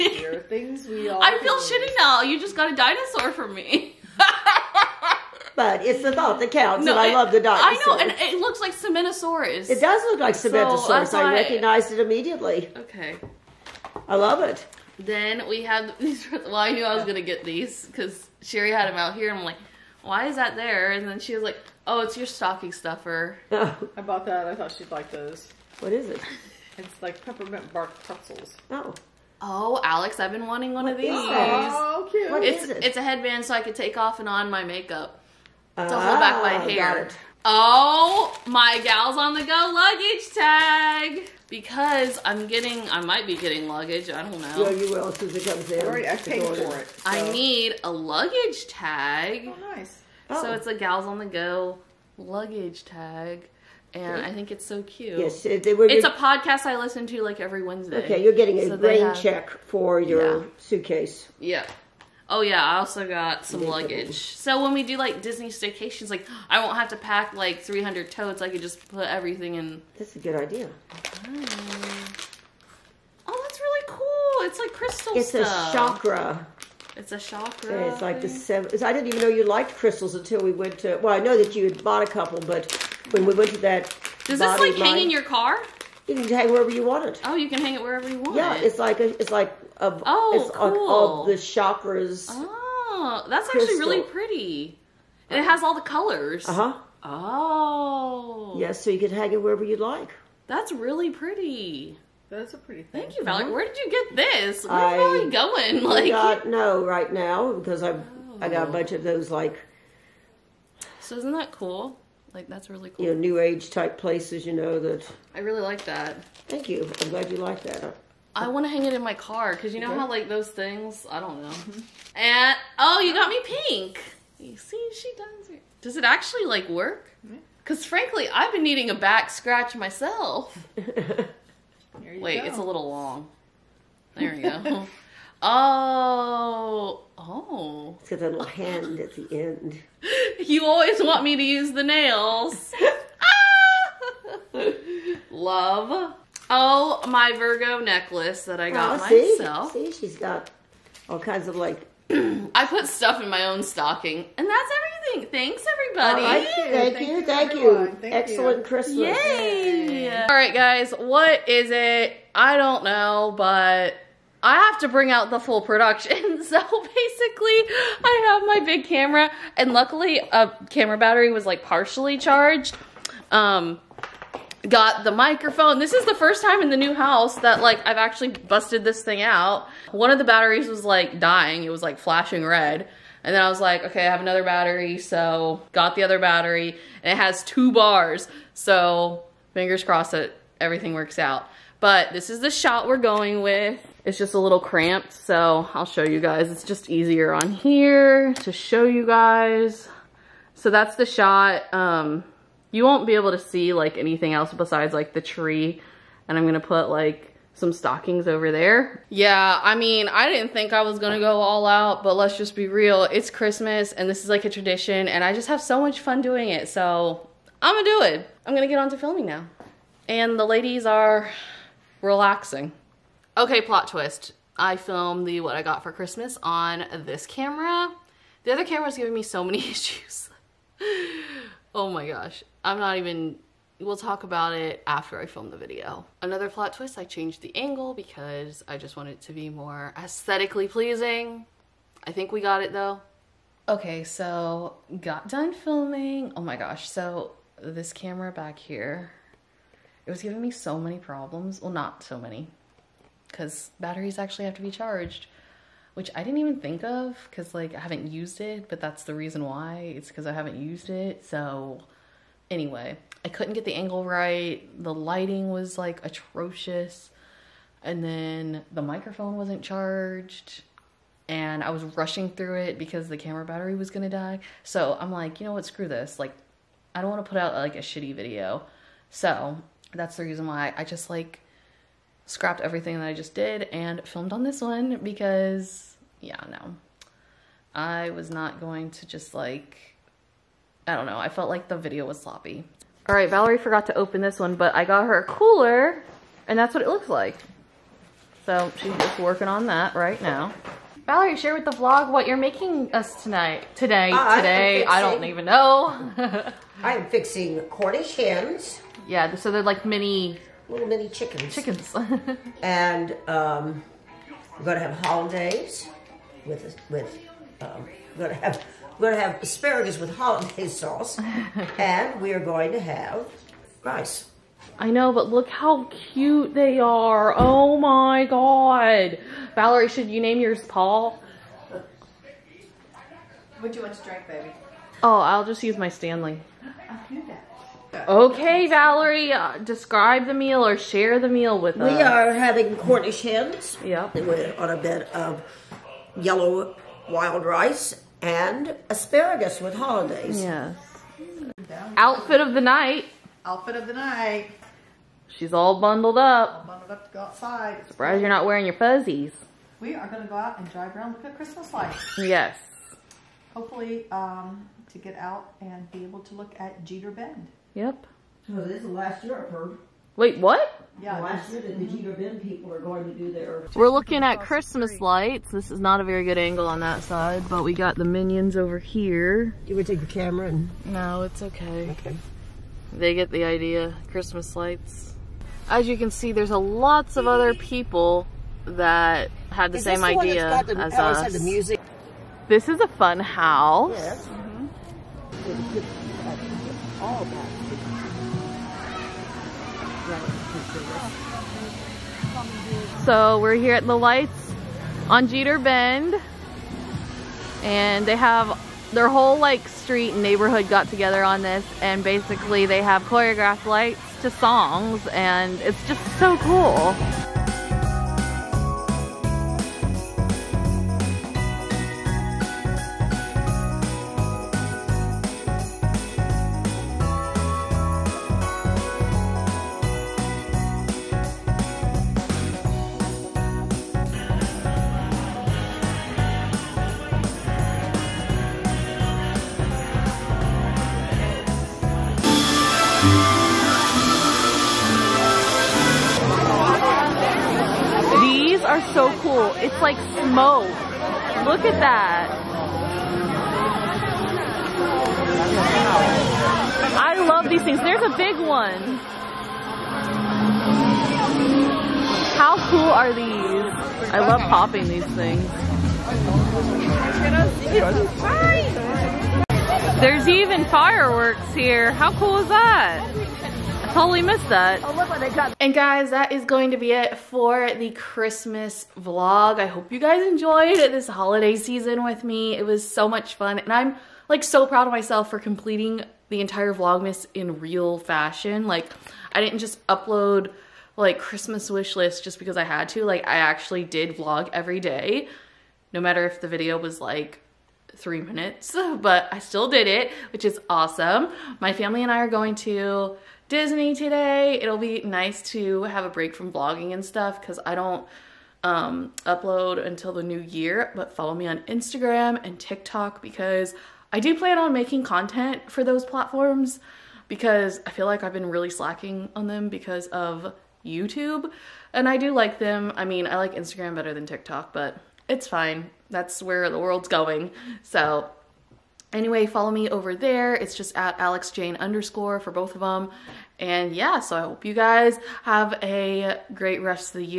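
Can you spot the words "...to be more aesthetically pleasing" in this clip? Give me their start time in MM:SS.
03:59.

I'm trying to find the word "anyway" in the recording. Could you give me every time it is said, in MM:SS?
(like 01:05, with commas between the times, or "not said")
04:22, 08:49.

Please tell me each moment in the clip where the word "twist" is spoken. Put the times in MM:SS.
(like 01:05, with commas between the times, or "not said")
03:43, 03:56.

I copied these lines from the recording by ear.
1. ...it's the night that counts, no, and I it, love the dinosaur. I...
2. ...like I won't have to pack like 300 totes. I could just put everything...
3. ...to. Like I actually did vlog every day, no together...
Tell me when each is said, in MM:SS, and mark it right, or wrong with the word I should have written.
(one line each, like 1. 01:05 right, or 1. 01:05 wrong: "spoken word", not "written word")
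1. 00:05 wrong: "thought", not "night"
2. 01:06 right
3. 08:12 wrong: "matter", not "together".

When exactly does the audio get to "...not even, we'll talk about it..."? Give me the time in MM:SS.
03:52.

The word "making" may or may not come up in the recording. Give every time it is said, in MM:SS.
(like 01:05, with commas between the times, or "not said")
05:02, 08:34.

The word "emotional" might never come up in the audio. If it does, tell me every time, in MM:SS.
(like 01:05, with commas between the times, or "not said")
not said.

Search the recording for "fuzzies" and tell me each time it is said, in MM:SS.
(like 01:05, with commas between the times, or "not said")
05:58.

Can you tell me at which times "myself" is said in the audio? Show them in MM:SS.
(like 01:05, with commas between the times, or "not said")
02:09, 02:29, 08:04.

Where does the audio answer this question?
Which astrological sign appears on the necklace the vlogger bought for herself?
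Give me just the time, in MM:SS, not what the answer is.
02:27.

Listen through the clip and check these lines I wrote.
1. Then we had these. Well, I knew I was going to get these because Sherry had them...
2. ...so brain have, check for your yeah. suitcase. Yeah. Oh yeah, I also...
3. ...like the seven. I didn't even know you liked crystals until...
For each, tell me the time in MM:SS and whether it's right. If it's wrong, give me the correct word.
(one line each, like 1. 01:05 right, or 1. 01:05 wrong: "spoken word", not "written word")
1. 00:14 right
2. 00:58 right
3. 01:18 right.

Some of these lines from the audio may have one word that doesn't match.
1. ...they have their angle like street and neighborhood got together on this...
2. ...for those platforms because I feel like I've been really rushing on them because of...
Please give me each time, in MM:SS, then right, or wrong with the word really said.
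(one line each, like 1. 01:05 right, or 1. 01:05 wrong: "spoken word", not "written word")
1. 06:48 wrong: "whole", not "angle"
2. 08:35 wrong: "slacking", not "rushing".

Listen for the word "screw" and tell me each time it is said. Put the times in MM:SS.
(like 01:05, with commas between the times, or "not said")
04:35.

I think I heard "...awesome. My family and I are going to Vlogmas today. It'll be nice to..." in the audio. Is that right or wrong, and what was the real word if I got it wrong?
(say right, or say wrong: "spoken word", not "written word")
wrong: "Disney", not "Vlogmas".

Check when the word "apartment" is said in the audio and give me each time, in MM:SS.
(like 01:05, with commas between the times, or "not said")
not said.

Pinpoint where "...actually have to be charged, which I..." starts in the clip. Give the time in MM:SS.
04:14.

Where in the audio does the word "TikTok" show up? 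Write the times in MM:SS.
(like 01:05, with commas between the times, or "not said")
08:32, 08:44.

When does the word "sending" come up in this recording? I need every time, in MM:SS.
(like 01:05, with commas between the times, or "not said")
not said.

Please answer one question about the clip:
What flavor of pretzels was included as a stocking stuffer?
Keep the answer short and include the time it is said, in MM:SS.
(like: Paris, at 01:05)
Peppermint bark, at 00:27.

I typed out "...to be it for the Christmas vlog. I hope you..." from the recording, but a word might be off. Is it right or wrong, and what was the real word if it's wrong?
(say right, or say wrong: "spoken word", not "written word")
right.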